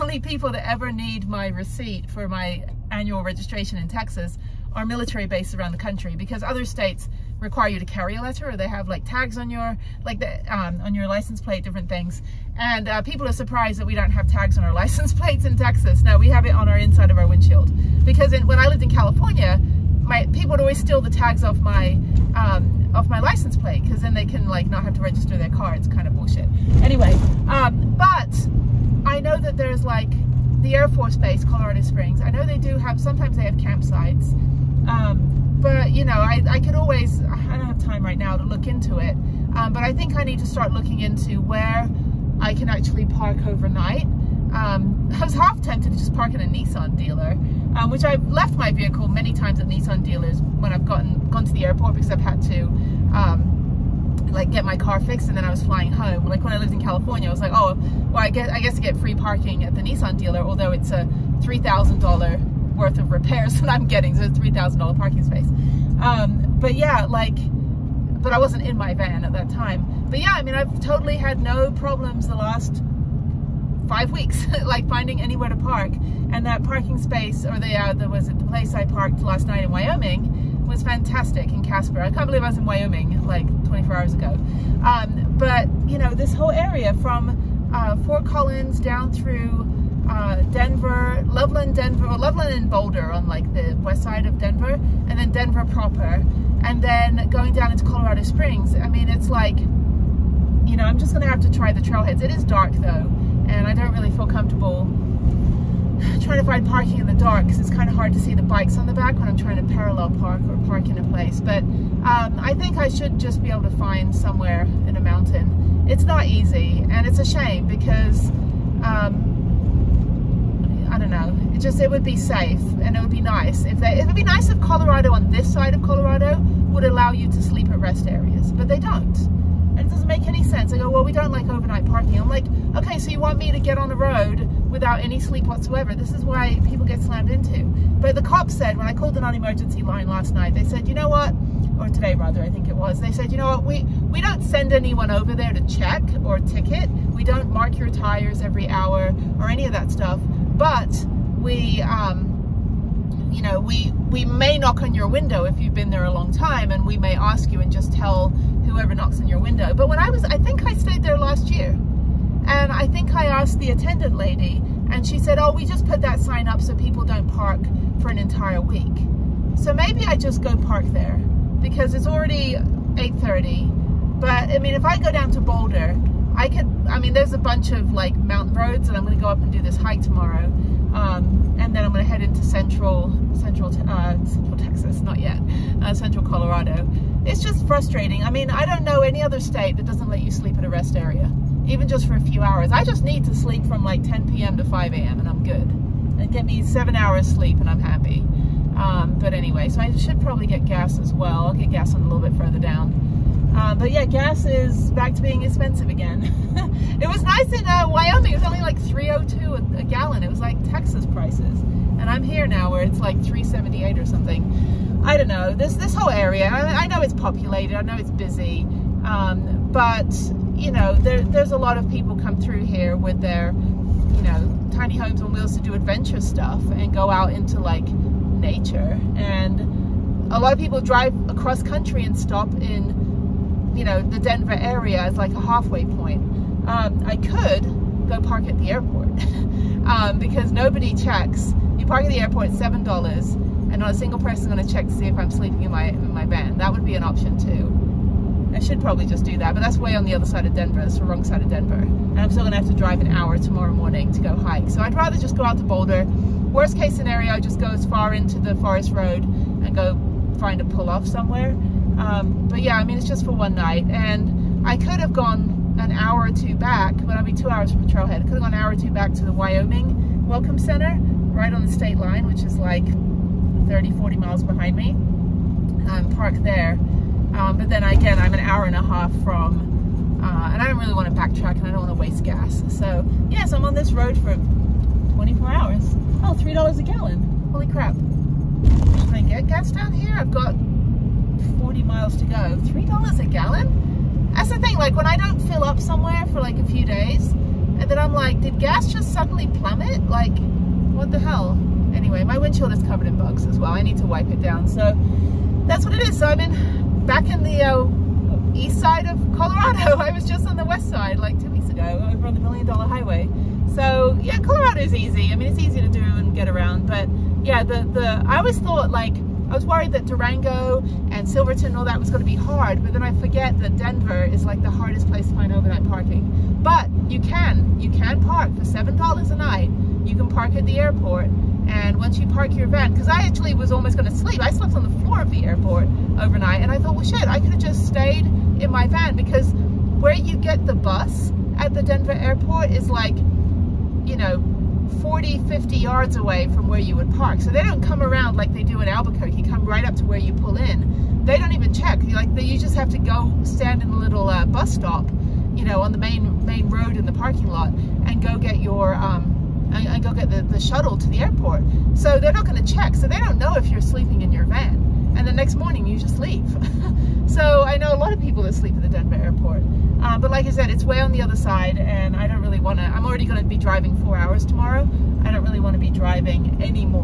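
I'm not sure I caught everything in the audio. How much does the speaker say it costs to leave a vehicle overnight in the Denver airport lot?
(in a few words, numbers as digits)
$7.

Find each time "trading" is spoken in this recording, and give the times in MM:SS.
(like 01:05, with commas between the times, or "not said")
not said.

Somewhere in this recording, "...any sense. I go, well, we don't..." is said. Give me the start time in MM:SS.
02:10.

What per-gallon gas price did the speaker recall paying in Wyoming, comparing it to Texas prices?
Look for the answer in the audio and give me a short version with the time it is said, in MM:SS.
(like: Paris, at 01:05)
$3.02, at 03:28.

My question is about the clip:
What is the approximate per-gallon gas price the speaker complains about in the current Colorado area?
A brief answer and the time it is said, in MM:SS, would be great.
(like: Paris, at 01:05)
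$3.78, at 03:33.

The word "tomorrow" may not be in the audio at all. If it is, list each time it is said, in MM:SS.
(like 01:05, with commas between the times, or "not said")
03:00, 04:13, 06:14.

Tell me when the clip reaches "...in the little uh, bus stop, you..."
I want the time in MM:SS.
05:53.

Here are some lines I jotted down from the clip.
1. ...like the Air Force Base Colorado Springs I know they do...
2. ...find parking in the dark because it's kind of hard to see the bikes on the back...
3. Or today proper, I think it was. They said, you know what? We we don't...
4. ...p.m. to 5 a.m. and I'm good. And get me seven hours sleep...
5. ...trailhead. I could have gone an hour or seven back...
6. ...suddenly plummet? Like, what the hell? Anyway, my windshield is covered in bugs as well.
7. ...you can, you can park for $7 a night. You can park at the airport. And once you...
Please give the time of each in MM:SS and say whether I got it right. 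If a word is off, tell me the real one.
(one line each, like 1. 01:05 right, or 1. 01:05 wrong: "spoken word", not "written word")
1. 00:29 right
2. 01:46 right
3. 02:21 wrong: "rather", not "proper"
4. 03:14 right
5. 04:27 wrong: "two", not "seven"
6. 04:59 right
7. 05:27 right.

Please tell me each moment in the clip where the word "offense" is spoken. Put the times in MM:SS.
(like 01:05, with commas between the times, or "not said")
not said.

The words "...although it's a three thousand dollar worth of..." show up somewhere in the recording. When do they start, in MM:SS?
01:00.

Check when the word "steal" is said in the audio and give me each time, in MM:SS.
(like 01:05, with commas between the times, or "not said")
00:20.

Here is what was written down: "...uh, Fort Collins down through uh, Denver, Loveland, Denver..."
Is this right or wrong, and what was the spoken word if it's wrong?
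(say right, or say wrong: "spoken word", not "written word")
right.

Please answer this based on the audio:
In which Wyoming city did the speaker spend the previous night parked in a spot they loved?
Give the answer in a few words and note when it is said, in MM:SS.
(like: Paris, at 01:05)
Casper, at 01:21.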